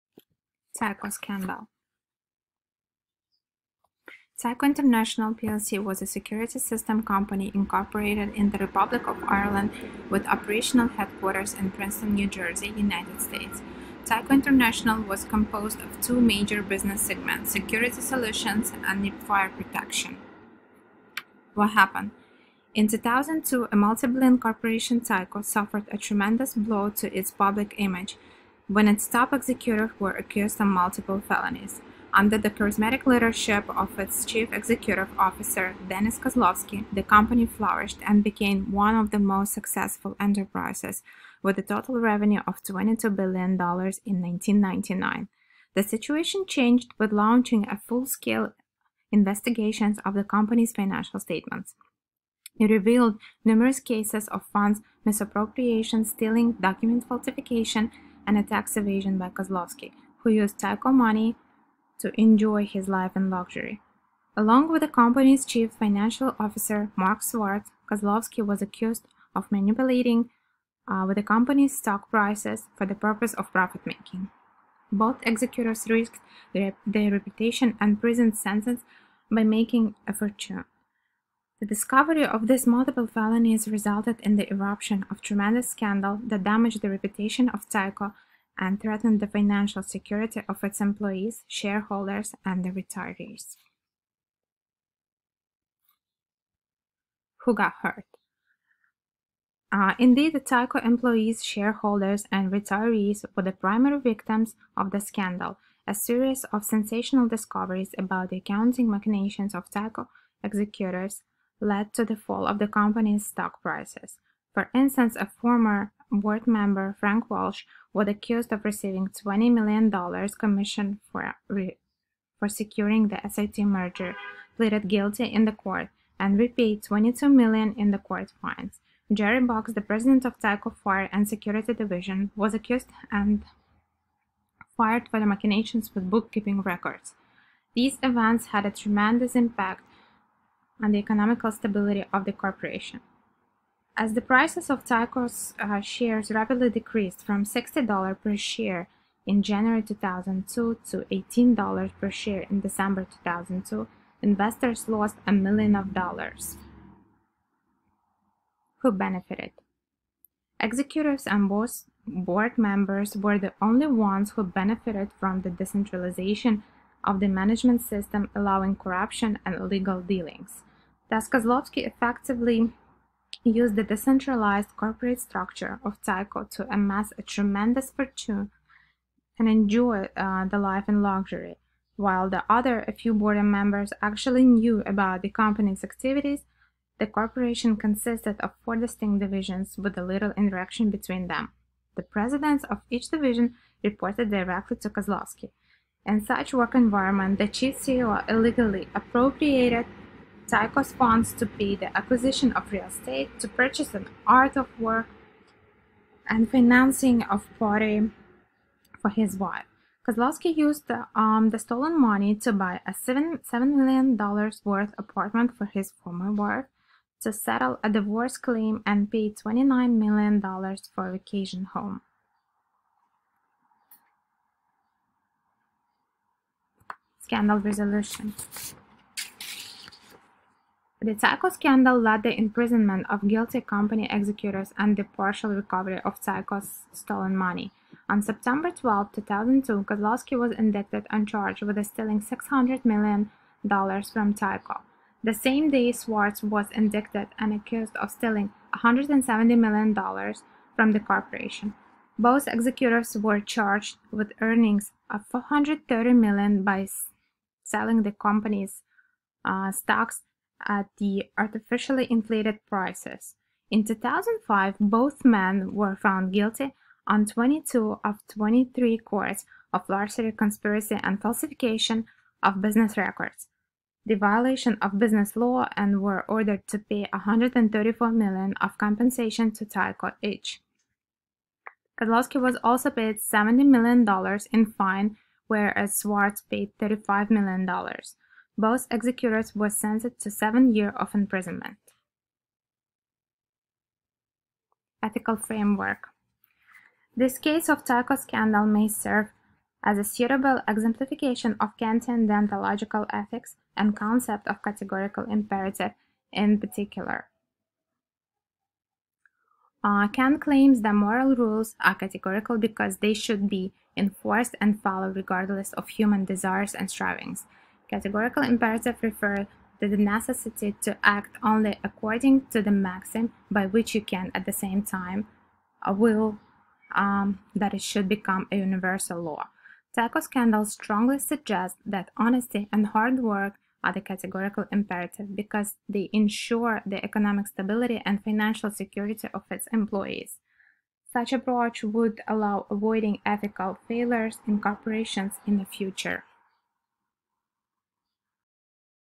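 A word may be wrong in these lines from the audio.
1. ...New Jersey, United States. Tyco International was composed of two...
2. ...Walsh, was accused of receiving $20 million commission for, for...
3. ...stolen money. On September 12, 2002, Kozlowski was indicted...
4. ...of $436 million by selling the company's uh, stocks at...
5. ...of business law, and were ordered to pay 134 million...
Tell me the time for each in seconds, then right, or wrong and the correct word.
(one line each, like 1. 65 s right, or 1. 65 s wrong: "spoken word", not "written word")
1. 12 s right
2. 117 s right
3. 236 s right
4. 255 s wrong: "430", not "436"
5. 274 s right.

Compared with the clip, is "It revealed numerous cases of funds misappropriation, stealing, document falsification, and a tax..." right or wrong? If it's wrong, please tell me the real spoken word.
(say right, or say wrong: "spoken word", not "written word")
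right.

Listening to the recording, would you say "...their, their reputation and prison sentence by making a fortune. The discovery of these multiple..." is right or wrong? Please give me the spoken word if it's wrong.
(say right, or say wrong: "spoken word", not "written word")
right.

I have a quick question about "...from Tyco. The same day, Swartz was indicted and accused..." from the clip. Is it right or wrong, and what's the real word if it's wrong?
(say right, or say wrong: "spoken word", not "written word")
right.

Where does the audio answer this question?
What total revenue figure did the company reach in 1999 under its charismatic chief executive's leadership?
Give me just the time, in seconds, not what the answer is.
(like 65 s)
42 s.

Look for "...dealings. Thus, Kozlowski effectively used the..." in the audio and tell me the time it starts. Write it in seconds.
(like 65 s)
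170 s.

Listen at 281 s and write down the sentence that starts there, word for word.
Kozlowski was also paid $70 million in fine, whereas Swartz paid $35 million.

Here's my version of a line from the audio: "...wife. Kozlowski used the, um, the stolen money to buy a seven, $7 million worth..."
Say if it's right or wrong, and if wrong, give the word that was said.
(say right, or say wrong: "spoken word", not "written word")
right.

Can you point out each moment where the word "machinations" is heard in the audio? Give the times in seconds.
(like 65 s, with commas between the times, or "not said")
108 s, 135 s.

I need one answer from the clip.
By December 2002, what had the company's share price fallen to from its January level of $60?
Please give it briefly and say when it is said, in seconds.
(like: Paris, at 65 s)
$18 per share, at 151 s.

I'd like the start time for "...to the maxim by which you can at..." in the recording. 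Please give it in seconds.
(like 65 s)
322 s.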